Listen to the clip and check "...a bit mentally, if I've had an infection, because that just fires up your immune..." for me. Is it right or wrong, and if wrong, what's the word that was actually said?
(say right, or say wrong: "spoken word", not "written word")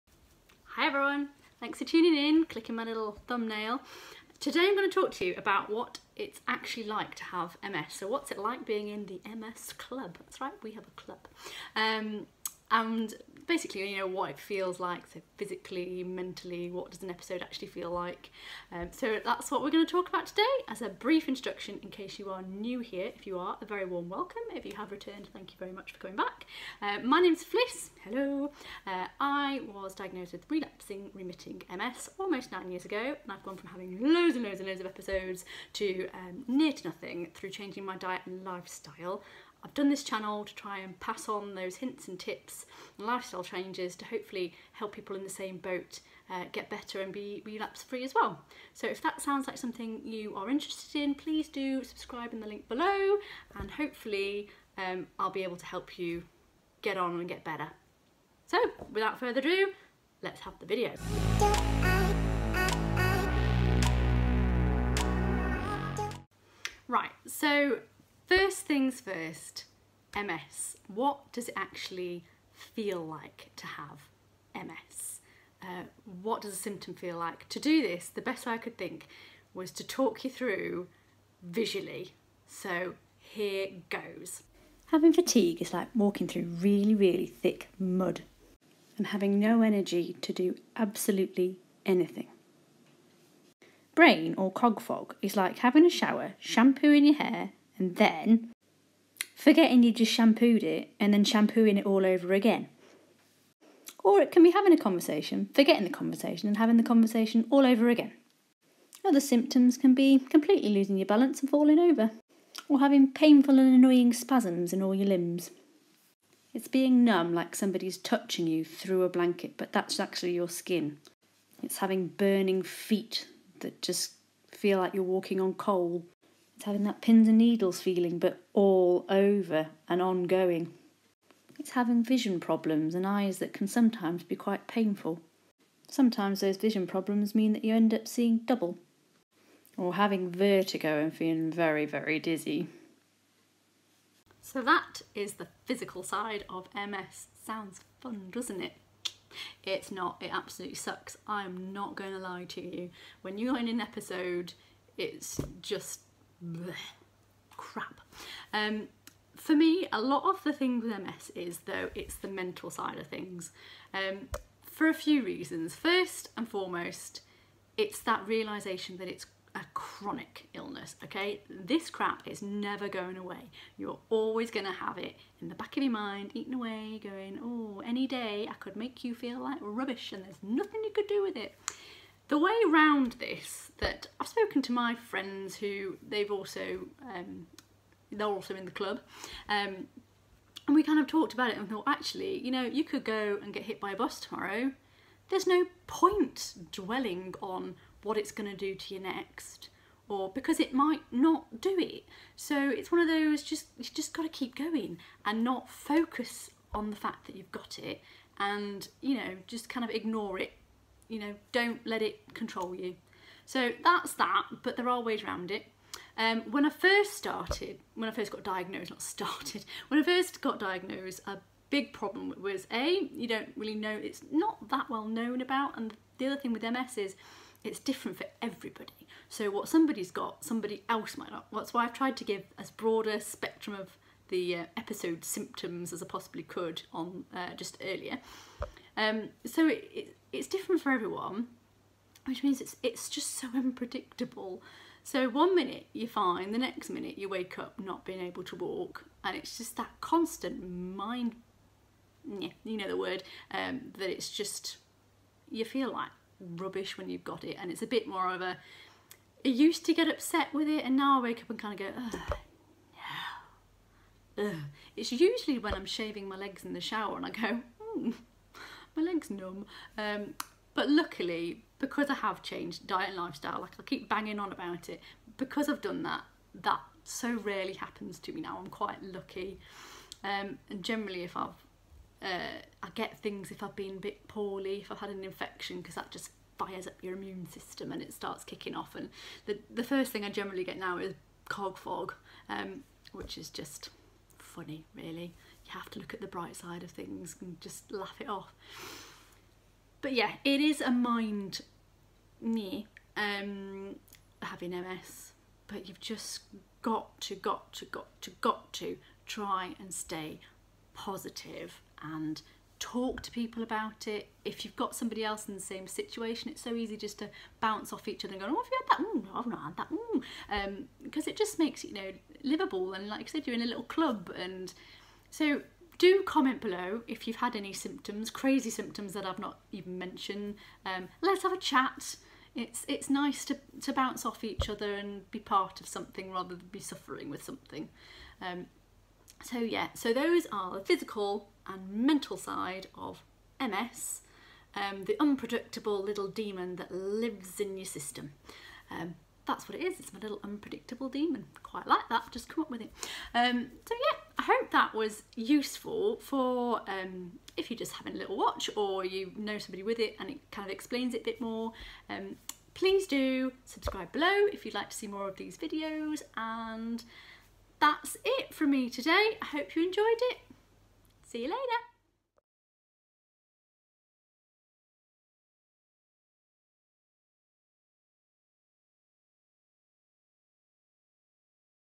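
wrong: "poorly", not "mentally".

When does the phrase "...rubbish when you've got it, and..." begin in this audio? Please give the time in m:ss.
4:16.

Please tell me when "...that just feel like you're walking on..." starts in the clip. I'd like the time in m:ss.
2:03.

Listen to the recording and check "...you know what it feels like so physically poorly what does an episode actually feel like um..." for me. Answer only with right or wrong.
wrong.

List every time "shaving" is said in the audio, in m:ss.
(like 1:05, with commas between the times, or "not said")
4:25.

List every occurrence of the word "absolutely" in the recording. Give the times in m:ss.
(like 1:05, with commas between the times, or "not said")
1:30, 2:30.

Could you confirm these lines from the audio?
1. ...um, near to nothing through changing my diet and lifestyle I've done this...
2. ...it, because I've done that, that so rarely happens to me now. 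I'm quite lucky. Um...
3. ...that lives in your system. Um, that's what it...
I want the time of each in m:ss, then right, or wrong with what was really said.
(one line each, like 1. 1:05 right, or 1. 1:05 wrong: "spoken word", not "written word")
1. 0:36 right
2. 4:34 right
3. 5:46 right.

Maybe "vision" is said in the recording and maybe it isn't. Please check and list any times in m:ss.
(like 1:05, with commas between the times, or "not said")
2:12, 2:16.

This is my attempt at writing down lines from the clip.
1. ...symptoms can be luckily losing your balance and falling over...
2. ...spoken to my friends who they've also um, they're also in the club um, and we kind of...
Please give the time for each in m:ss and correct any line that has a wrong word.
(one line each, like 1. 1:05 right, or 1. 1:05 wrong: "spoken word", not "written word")
1. 1:49 wrong: "completely", not "luckily"
2. 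3:04 right.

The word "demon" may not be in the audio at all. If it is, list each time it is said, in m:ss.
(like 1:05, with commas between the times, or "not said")
5:46, 5:51.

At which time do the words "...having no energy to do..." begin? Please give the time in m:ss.
1:29.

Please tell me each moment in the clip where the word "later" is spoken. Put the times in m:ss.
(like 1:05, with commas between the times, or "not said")
6:11.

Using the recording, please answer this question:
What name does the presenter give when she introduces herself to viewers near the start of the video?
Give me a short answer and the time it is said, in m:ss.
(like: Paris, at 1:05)
Fliss, at 0:27.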